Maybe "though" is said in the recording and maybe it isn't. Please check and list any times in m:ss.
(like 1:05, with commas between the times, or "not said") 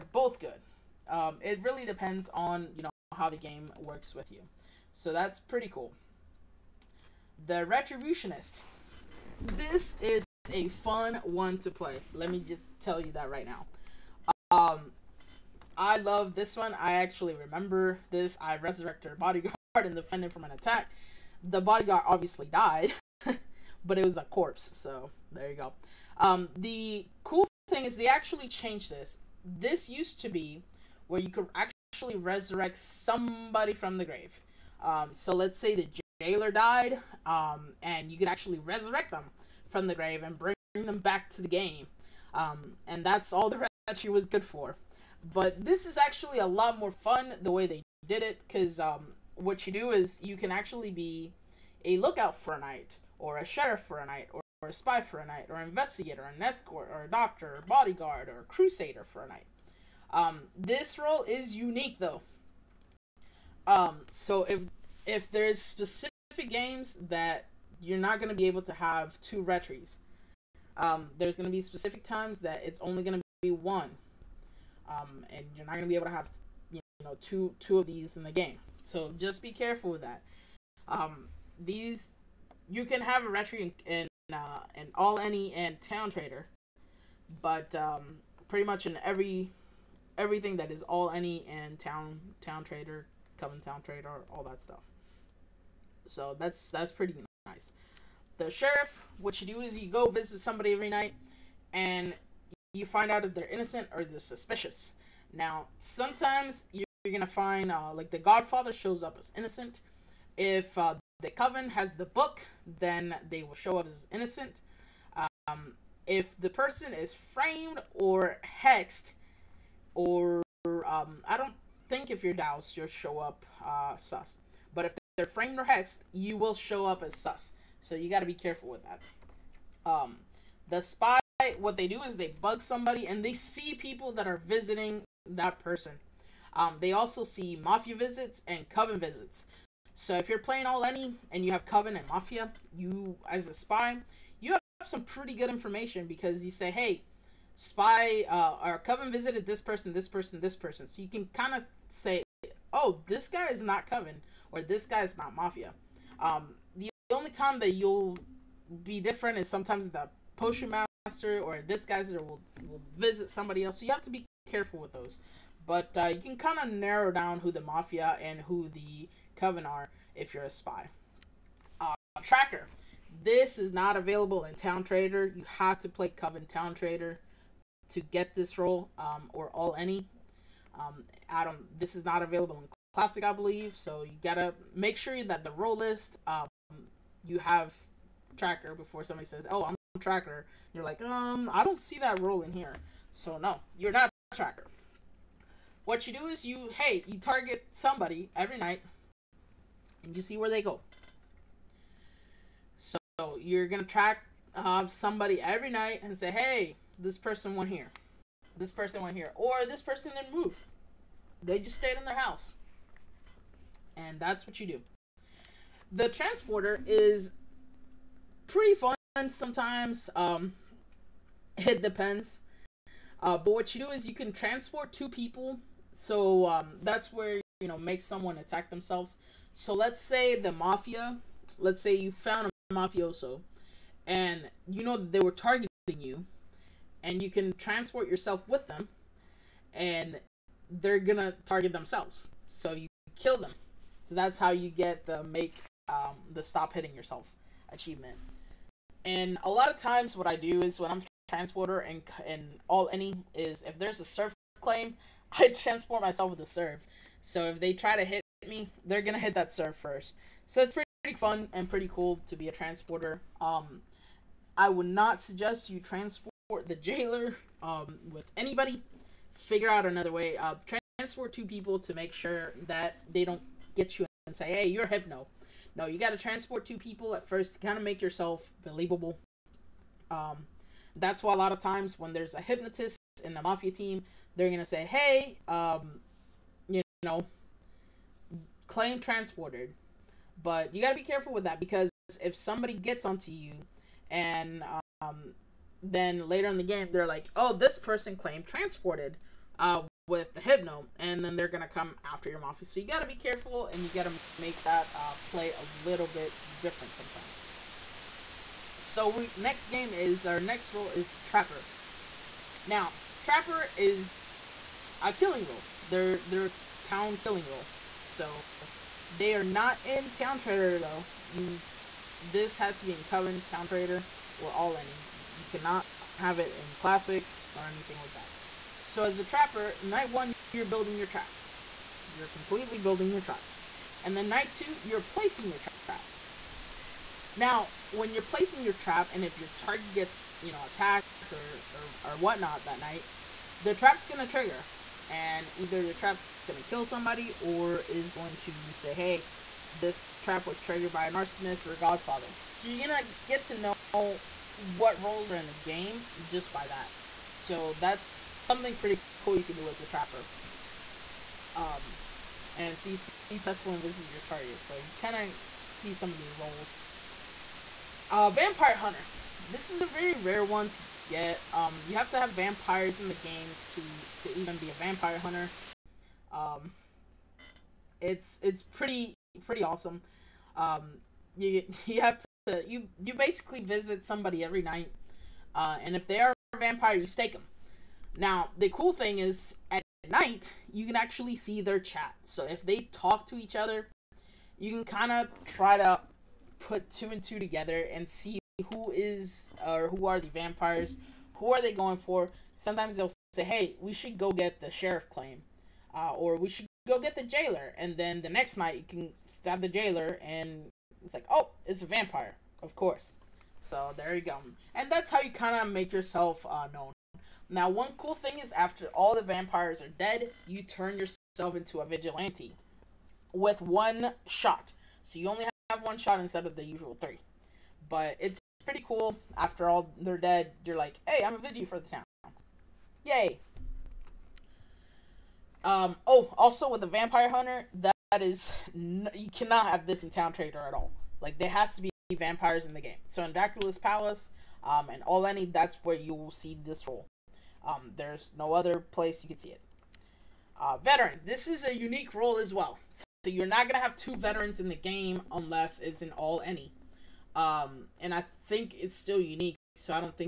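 1:01, 5:20.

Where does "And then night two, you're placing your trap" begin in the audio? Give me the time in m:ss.
5:34.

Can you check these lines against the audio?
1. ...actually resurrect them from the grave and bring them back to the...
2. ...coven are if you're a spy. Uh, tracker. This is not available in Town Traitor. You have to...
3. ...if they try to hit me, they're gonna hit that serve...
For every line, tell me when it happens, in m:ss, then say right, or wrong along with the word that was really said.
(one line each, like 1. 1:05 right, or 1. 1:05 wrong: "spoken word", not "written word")
1. 0:38 right
2. 2:49 right
3. 4:17 right.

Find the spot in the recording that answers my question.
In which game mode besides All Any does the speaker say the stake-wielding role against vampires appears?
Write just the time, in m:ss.
7:23.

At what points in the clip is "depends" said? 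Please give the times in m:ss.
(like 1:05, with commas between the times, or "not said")
0:01, 3:41.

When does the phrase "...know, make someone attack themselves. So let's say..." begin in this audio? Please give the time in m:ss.
3:47.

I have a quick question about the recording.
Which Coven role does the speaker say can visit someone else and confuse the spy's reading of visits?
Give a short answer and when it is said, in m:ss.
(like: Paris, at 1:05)
Potion master, at 2:40.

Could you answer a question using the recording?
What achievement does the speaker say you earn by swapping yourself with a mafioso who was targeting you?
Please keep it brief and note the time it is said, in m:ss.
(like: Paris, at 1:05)
Stop hitting yourself, at 4:06.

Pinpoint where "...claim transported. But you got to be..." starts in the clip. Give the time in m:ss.
4:48.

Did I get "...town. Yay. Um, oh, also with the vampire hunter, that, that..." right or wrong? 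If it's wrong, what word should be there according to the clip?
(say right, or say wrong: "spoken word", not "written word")
right.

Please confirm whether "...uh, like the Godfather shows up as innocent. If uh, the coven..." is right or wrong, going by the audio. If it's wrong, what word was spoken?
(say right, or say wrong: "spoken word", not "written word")
right.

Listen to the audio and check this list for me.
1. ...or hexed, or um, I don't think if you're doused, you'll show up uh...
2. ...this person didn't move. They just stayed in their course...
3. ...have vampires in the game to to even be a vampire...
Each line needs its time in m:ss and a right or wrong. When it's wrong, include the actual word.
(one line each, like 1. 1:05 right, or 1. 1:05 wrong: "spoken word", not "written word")
1. 1:57 right
2. 3:29 wrong: "house", not "course"
3. 6:12 right.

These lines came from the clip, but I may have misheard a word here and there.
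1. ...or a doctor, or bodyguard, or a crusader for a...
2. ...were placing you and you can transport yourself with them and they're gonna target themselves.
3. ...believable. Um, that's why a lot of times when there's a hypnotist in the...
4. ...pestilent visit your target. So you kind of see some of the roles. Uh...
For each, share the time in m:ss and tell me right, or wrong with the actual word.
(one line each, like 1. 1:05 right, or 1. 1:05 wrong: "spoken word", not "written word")
1. 0:56 right
2. 3:55 wrong: "targeting", not "placing"
3. 4:38 right
4. 6:03 right.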